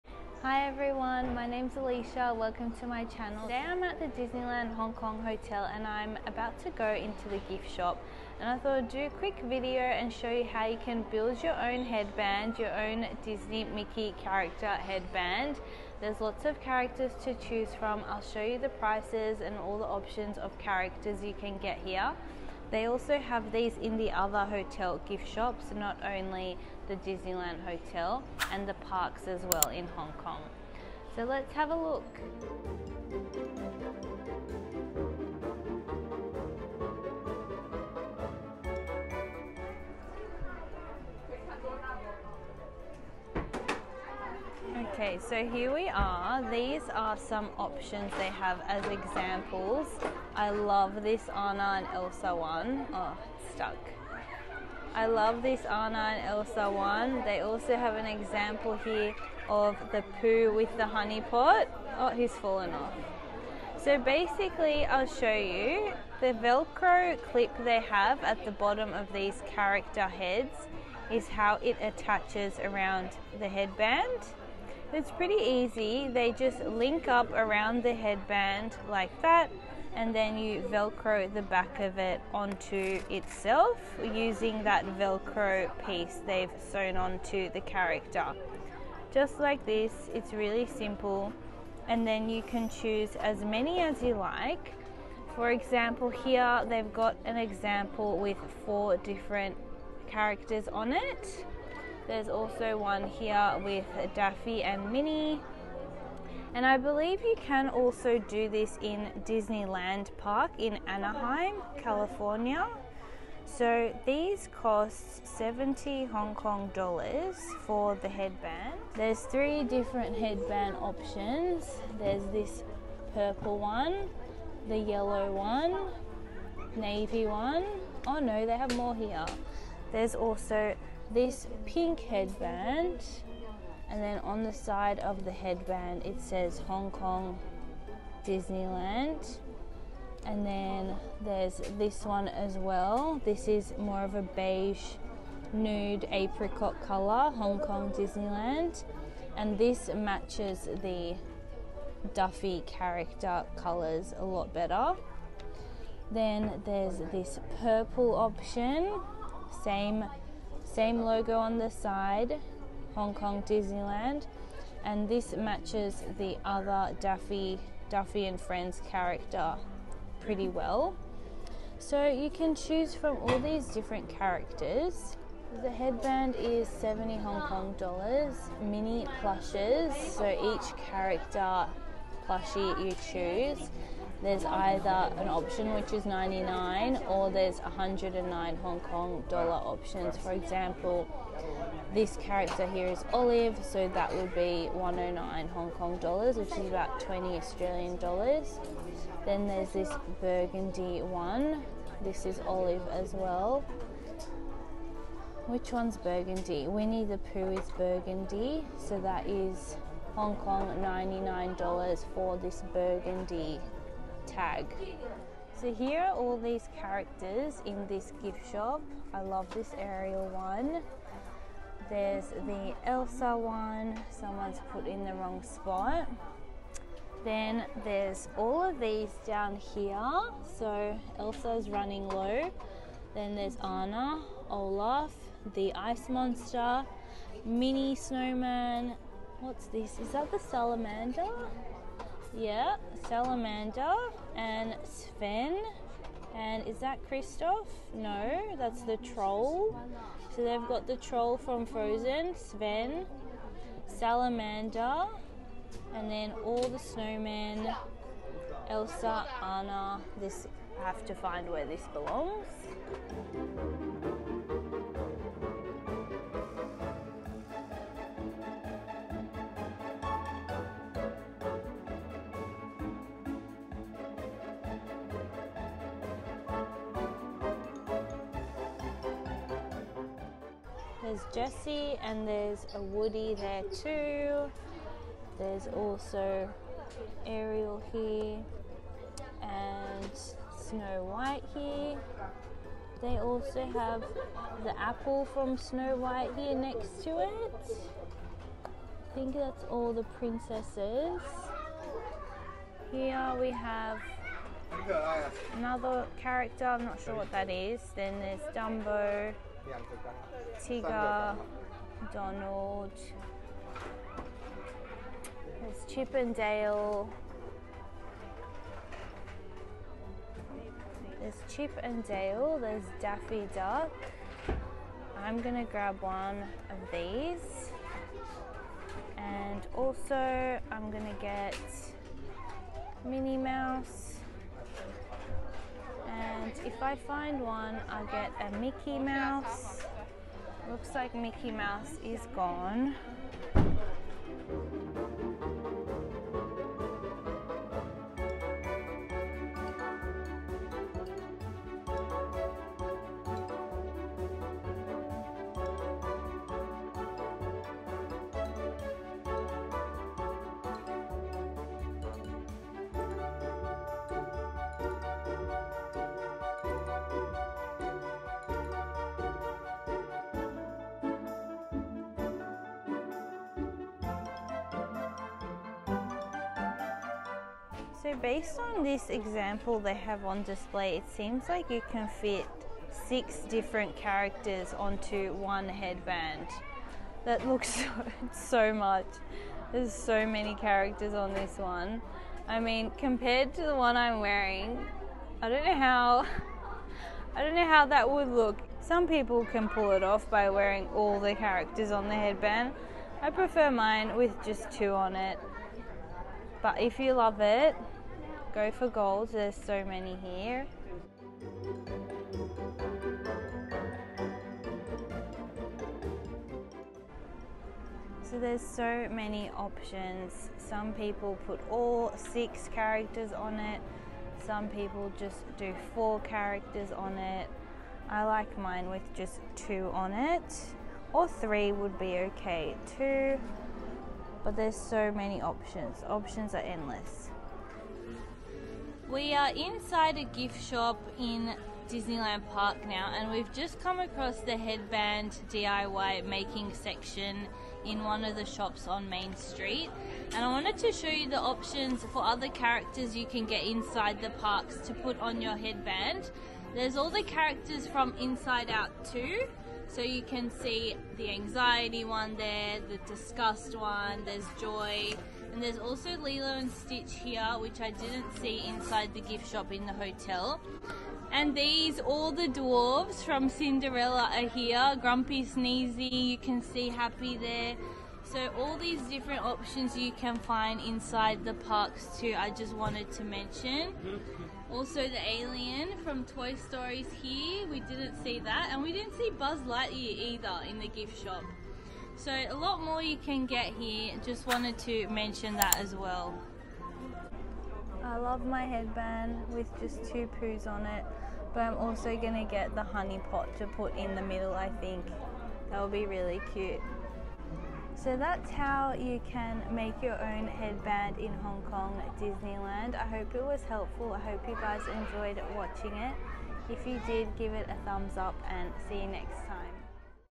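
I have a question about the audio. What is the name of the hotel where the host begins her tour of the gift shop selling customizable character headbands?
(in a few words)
Disneyland Hong Kong Hotel.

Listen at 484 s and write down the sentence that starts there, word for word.
Also the alien from Toy Story's here, we didn't see that.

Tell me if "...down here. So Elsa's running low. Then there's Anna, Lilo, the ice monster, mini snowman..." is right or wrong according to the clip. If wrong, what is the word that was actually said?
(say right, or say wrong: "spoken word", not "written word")
wrong: "Olaf", not "Lilo".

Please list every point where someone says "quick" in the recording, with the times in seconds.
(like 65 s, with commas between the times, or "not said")
9 s.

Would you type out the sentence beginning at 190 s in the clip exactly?
For example, this character here is Olive, so that would be 109 Hong Kong dollars, which is about 20 Australian dollars.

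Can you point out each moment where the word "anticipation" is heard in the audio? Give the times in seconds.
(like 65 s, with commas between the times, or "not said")
not said.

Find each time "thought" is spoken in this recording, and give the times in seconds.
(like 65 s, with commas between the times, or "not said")
8 s.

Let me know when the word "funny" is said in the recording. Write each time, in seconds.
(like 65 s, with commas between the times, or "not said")
not said.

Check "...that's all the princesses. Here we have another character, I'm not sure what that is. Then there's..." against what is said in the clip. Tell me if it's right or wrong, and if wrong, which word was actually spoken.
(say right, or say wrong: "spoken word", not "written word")
right.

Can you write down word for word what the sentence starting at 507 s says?
So that's how you can make your own headband in Hong Kong Disneyland.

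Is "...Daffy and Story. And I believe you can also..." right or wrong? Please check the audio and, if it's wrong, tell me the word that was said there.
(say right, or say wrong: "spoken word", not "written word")
wrong: "Minnie", not "Story".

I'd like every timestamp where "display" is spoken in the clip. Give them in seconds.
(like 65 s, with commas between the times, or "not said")
380 s.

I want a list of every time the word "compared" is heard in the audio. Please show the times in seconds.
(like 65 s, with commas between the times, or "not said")
392 s.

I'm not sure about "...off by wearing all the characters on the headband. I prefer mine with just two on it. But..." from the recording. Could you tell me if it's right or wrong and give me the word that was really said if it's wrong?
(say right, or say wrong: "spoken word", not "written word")
right.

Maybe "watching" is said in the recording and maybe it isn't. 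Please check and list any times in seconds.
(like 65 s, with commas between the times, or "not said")
515 s.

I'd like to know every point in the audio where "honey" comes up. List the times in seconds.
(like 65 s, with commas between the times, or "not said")
60 s, 502 s.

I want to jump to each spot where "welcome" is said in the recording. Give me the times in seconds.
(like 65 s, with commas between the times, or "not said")
2 s.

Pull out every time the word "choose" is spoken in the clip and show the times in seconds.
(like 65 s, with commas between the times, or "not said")
17 s, 92 s, 172 s, 183 s.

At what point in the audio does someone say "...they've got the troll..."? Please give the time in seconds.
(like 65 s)
250 s.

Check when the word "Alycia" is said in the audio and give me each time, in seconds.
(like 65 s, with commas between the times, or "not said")
1 s.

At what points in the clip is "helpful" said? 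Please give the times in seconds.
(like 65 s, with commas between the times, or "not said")
513 s.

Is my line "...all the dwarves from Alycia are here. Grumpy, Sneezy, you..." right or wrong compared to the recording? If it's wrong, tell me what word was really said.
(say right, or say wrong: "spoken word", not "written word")
wrong: "Cinderella", not "Alycia".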